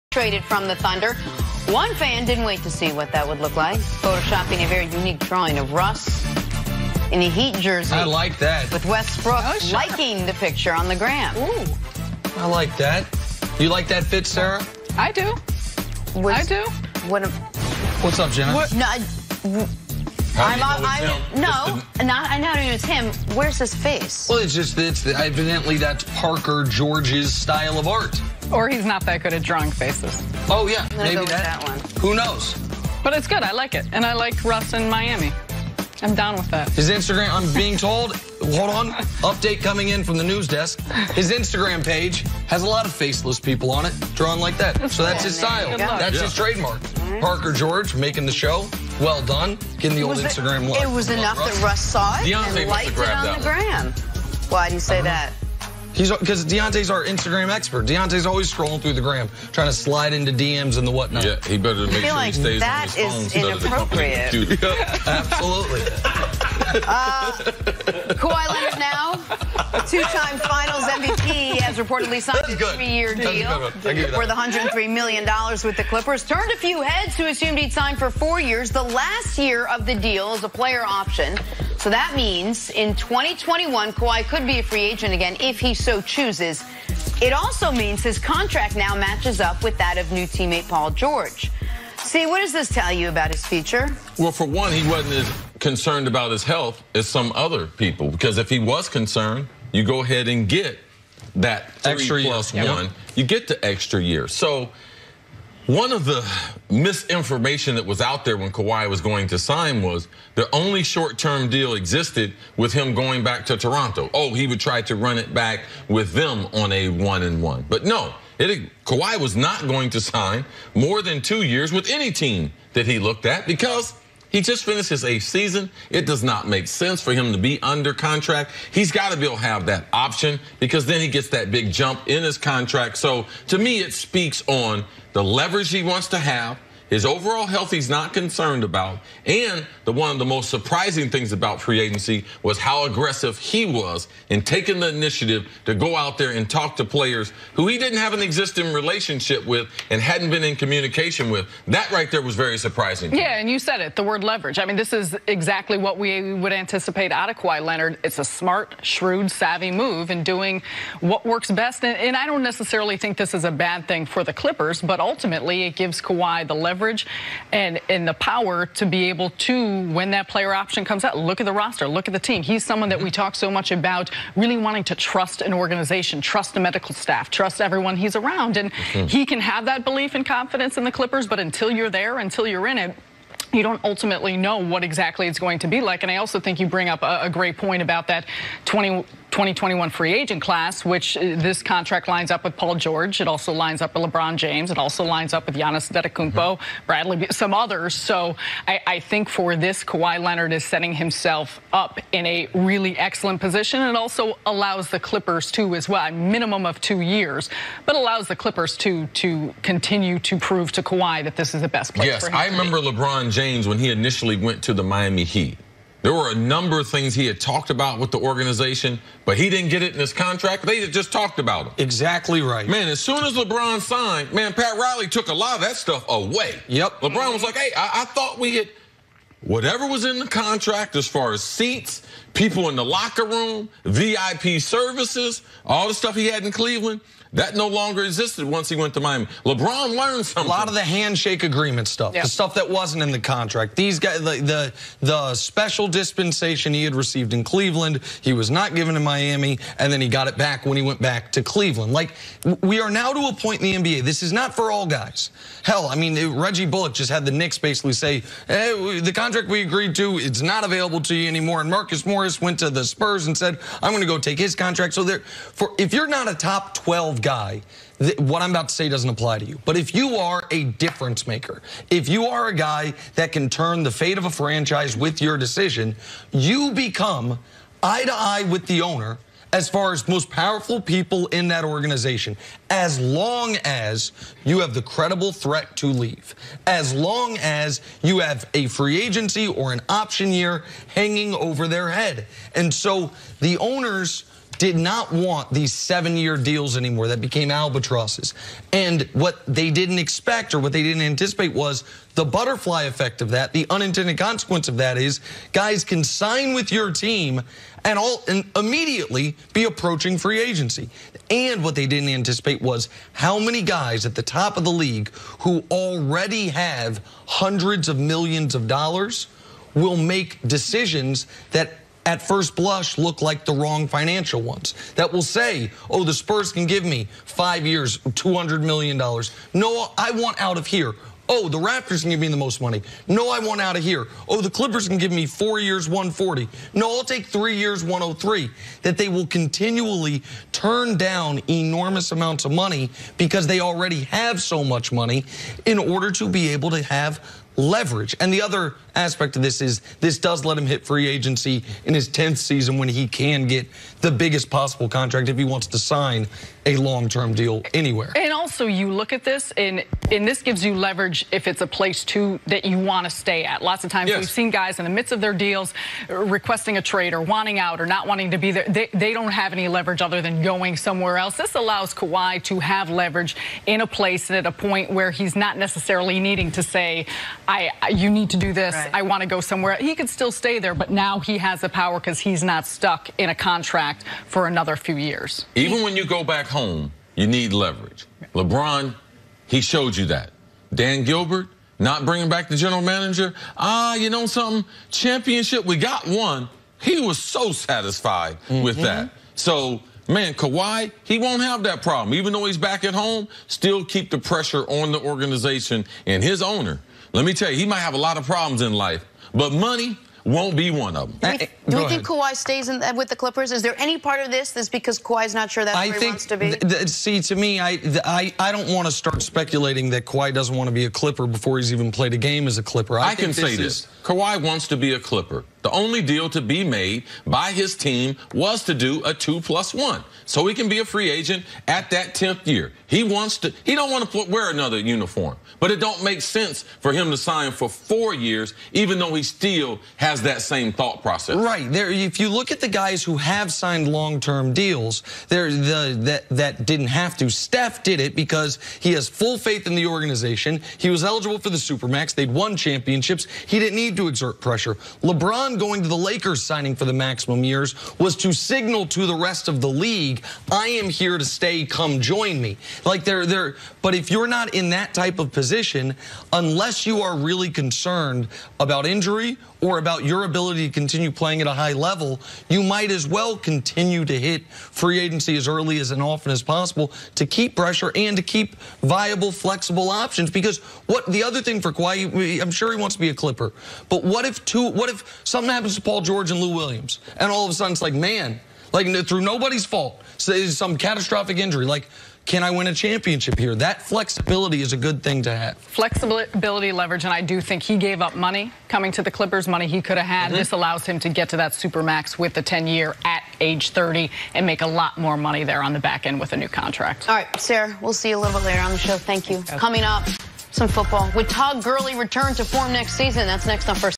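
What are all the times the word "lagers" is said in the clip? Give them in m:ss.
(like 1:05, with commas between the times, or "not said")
not said.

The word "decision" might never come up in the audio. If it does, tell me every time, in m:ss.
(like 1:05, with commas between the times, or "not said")
4:35, 5:20.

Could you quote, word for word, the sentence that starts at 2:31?
That right there was very surprising.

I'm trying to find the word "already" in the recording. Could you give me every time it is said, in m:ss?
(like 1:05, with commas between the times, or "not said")
5:15, 5:43.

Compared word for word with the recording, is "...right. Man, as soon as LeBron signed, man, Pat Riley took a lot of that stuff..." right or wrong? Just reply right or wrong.
right.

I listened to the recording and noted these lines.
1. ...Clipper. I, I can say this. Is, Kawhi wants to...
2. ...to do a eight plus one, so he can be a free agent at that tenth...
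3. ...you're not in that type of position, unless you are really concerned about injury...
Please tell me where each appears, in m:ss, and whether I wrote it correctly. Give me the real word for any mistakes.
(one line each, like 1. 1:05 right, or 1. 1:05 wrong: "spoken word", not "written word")
1. 7:02 right
2. 7:08 wrong: "two", not "eight"
3. 7:44 right.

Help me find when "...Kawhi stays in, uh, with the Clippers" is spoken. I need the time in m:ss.
6:52.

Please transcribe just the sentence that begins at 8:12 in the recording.
Can I win a championship here?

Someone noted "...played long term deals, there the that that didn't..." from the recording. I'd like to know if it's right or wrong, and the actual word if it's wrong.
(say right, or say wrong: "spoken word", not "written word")
wrong: "signed", not "played".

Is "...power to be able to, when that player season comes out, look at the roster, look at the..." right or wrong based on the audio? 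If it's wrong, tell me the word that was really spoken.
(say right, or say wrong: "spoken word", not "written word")
wrong: "option", not "season".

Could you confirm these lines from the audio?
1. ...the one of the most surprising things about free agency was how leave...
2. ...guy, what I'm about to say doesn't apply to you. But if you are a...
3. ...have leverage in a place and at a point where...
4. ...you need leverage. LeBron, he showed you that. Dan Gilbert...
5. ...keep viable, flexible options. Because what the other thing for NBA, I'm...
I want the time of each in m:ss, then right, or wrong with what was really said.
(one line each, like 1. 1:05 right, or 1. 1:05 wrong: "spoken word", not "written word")
1. 2:19 wrong: "aggressive", not "leave"
2. 4:27 right
3. 6:12 right
4. 6:27 right
5. 7:58 wrong: "Kawhi", not "NBA".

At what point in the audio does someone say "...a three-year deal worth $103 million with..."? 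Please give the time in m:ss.
1:12.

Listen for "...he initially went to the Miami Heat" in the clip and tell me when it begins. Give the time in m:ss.
3:33.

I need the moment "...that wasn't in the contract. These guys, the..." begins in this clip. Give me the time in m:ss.
4:02.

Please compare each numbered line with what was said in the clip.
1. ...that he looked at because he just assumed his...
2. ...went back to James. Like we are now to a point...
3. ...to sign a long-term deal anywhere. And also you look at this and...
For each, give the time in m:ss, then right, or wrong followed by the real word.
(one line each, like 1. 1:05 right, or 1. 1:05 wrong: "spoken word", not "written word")
1. 2:02 wrong: "finished", not "assumed"
2. 4:10 wrong: "Cleveland", not "James"
3. 5:55 right.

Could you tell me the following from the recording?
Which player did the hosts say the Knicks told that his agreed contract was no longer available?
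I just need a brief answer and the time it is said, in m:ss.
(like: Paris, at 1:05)
Reggie Bullock, at 4:16.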